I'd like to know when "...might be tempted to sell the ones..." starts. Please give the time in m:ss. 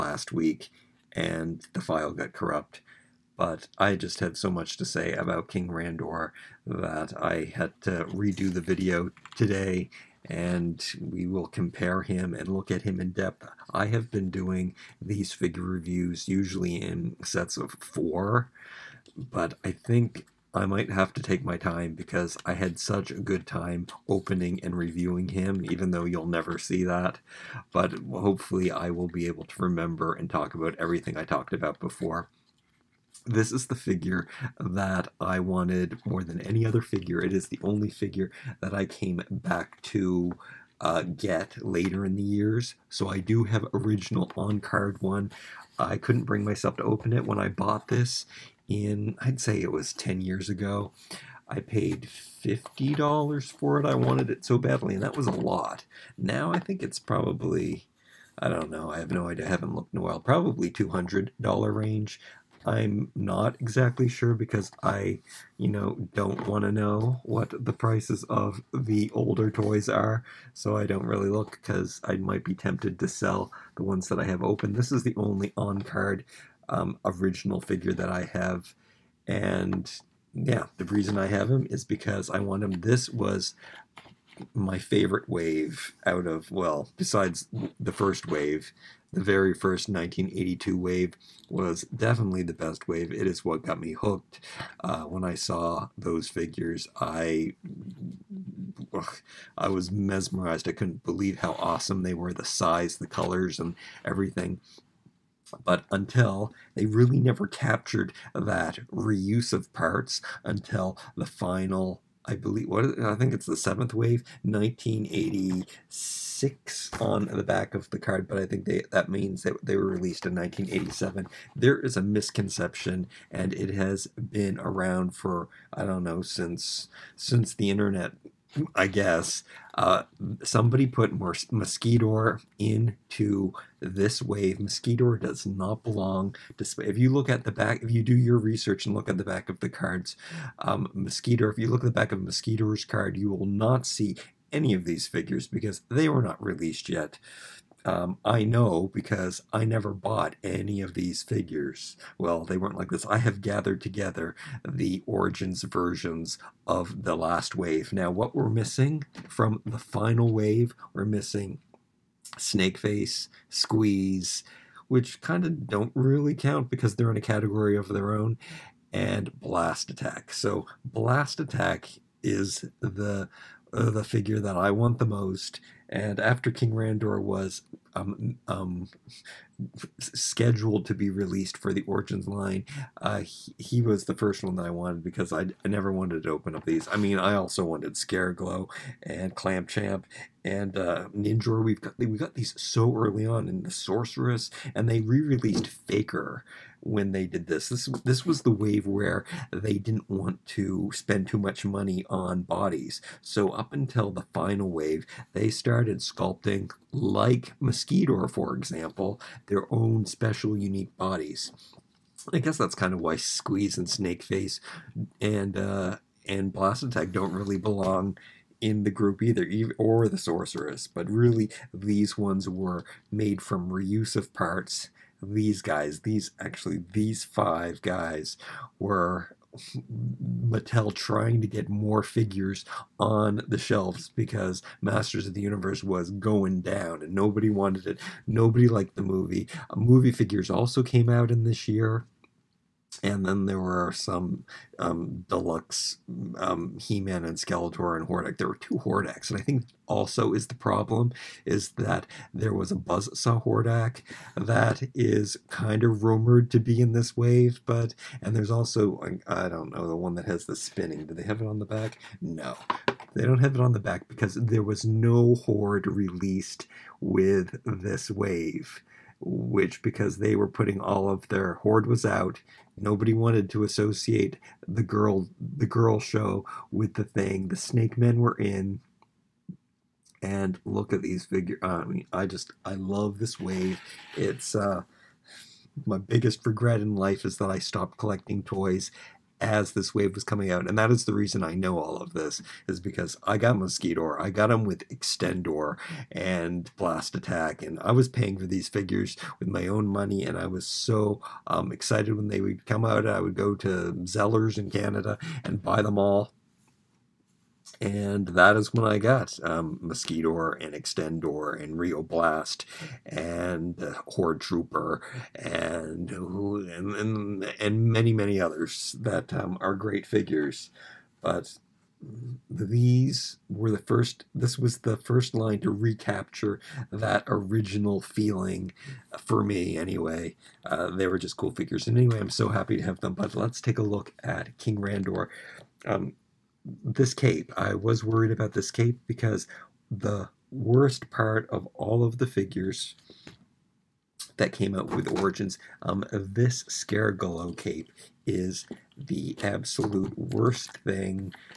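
1:12.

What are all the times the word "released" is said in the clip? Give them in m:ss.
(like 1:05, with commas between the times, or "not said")
1:59, 2:26, 3:01, 3:15, 4:25.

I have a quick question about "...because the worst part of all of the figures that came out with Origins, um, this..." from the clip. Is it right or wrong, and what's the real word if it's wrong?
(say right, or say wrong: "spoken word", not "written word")
right.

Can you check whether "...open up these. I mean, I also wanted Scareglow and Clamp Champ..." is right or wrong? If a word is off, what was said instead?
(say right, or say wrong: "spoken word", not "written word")
right.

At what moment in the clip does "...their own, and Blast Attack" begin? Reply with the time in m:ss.
2:47.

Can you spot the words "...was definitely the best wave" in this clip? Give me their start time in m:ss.
1:31.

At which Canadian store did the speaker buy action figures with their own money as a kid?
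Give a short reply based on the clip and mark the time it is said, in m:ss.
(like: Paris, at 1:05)
Zellers, at 5:04.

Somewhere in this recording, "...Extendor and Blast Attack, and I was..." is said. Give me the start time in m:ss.
4:54.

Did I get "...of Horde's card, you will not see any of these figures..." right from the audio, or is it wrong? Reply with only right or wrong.
wrong.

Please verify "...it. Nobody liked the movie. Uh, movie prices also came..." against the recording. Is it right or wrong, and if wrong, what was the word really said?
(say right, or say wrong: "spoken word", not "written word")
wrong: "figures", not "prices".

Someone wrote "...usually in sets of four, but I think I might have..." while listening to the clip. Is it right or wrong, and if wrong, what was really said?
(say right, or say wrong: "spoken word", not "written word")
right.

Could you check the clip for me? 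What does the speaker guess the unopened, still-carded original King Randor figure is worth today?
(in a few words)
$200.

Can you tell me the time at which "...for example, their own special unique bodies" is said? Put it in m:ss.
3:28.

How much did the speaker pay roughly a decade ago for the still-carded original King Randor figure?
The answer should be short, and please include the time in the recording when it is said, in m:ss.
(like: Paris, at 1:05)
$50, at 0:52.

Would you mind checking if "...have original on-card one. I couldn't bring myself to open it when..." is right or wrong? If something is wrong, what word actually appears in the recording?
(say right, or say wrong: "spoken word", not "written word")
right.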